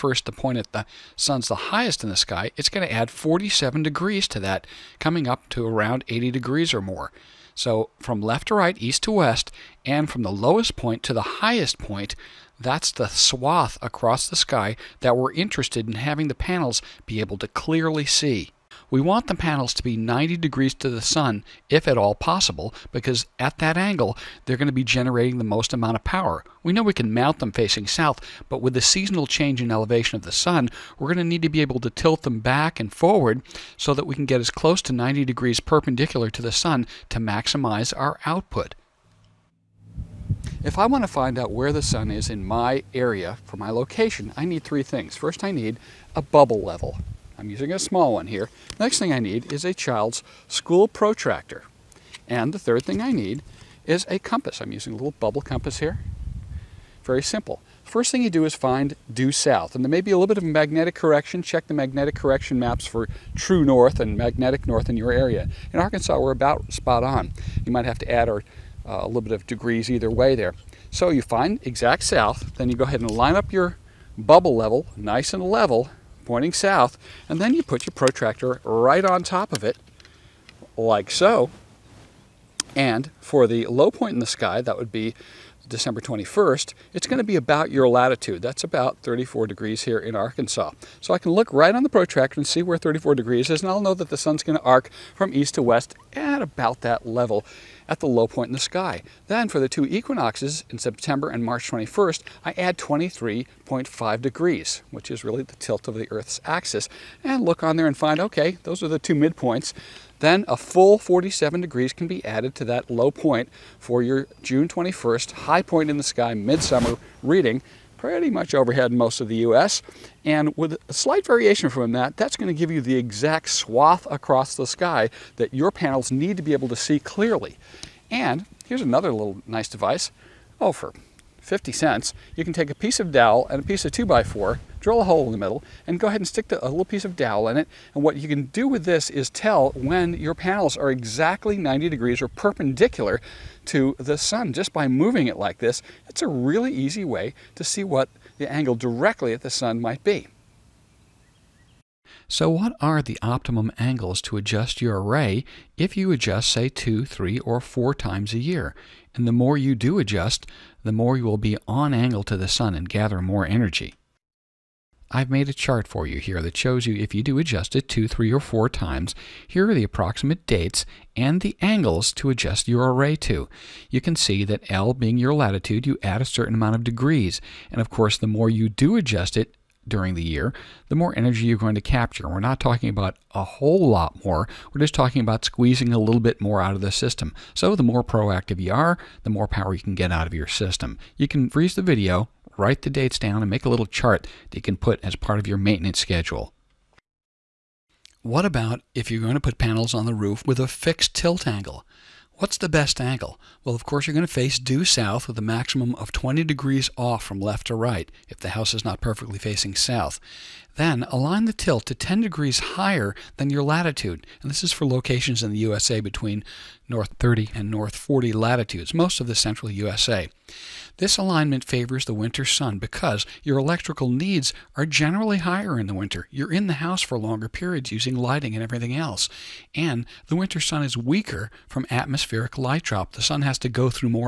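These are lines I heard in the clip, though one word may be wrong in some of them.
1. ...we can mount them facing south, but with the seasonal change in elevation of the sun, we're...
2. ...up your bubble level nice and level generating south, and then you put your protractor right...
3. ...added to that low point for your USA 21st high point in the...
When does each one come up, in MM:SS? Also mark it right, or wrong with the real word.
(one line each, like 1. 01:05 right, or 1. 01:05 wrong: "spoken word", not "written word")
1. 00:26 right
2. 01:13 wrong: "pointing", not "generating"
3. 01:52 wrong: "June", not "USA".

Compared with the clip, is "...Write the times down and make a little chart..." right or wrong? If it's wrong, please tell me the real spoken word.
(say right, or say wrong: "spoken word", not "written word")
wrong: "dates", not "times".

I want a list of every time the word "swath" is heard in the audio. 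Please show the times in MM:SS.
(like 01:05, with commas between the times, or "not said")
00:13, 02:03.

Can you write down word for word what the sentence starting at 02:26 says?
It's a really easy way to see what the angle directly at the sun might be.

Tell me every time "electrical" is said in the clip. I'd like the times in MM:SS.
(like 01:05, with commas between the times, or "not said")
03:43.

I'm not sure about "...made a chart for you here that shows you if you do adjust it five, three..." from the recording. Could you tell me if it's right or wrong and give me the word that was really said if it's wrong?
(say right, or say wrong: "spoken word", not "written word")
wrong: "two", not "five".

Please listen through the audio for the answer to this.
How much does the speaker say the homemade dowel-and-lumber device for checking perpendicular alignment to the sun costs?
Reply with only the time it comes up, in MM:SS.
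02:11.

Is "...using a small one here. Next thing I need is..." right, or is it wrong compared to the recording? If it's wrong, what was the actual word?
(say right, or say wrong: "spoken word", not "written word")
right.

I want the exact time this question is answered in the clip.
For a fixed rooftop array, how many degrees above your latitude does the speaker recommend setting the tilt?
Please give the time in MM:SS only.
03:31.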